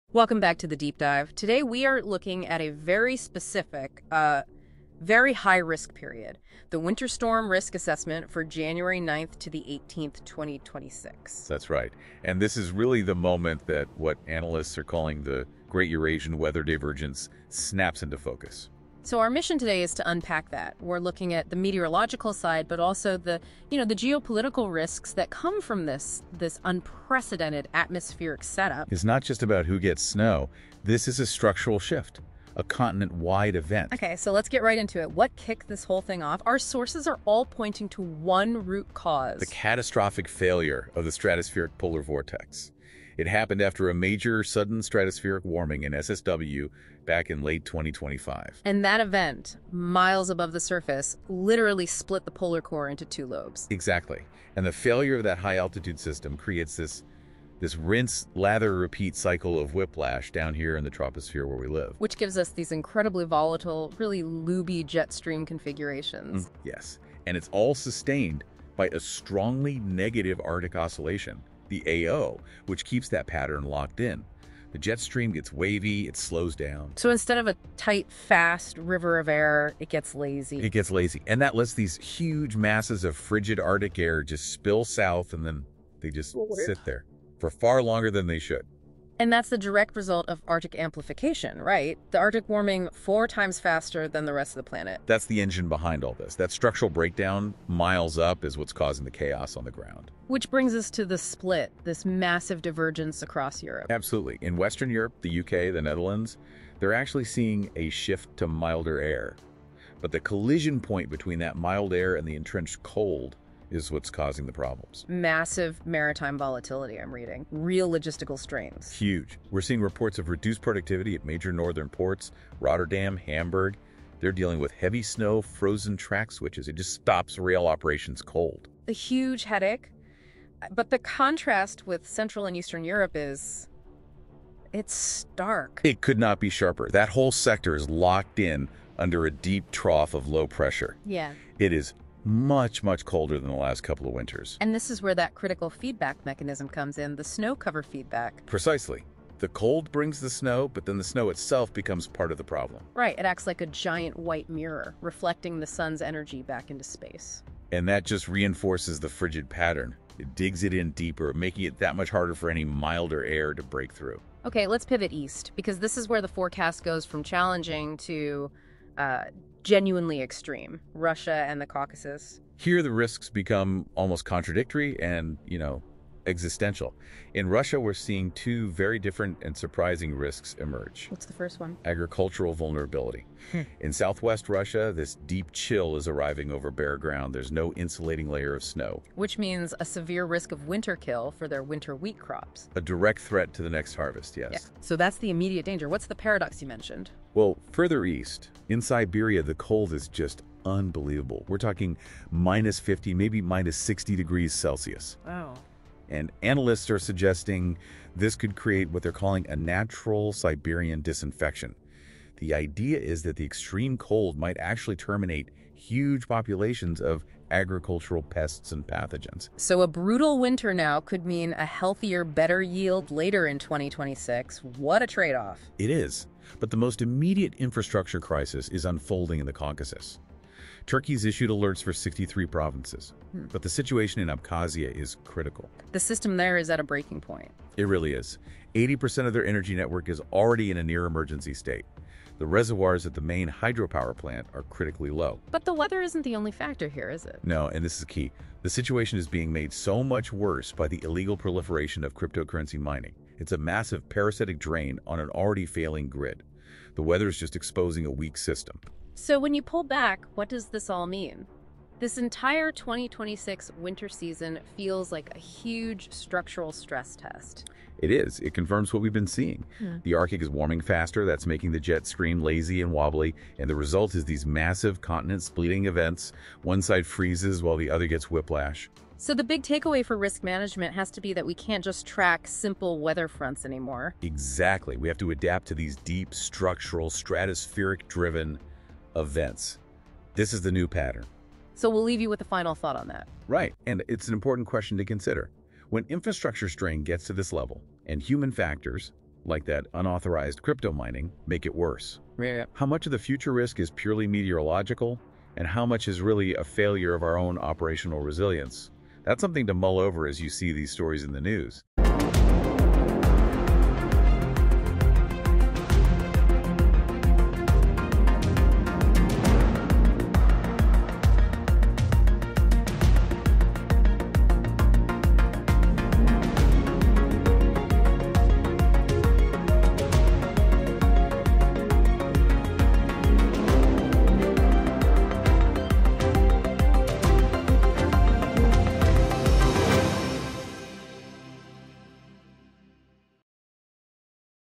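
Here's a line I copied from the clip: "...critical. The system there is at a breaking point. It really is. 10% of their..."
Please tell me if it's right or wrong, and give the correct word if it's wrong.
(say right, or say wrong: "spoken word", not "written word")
wrong: "80", not "10".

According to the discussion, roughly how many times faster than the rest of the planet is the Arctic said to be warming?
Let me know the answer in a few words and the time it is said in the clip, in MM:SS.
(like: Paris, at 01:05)
4, at 01:32.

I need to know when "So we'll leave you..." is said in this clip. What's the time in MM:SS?
04:51.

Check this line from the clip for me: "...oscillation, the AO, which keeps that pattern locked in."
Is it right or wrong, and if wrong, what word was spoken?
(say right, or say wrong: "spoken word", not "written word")
right.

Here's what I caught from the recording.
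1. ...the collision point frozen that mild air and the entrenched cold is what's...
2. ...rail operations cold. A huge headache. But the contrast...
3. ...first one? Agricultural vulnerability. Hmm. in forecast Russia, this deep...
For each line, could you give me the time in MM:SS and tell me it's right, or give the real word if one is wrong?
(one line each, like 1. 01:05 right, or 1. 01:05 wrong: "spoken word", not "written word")
1. 01:50 wrong: "between", not "frozen"
2. 02:07 right
3. 03:01 wrong: "southwest", not "forecast".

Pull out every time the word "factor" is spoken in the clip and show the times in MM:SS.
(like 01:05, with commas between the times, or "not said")
04:06, 04:58.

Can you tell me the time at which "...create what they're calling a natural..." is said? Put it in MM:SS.
03:28.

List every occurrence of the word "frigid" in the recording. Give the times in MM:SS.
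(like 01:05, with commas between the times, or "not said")
01:23, 02:39.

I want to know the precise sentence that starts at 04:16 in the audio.
The weather is just exposing a weak system.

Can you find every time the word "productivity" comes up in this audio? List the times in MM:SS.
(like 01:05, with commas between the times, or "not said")
02:00.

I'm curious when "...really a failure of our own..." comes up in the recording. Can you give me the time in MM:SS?
05:06.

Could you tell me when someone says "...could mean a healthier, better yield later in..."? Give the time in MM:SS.
03:40.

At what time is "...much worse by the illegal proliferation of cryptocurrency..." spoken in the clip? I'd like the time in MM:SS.
04:10.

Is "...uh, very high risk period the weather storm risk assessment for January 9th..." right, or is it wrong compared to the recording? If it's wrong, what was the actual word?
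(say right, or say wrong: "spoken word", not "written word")
wrong: "winter", not "weather".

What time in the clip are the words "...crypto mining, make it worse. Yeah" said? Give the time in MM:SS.
05:00.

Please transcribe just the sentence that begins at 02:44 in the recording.
Okay, let's pivot east, because this is where the forecast goes from challenging to uh, genuinely extreme Russia and the Caucasus.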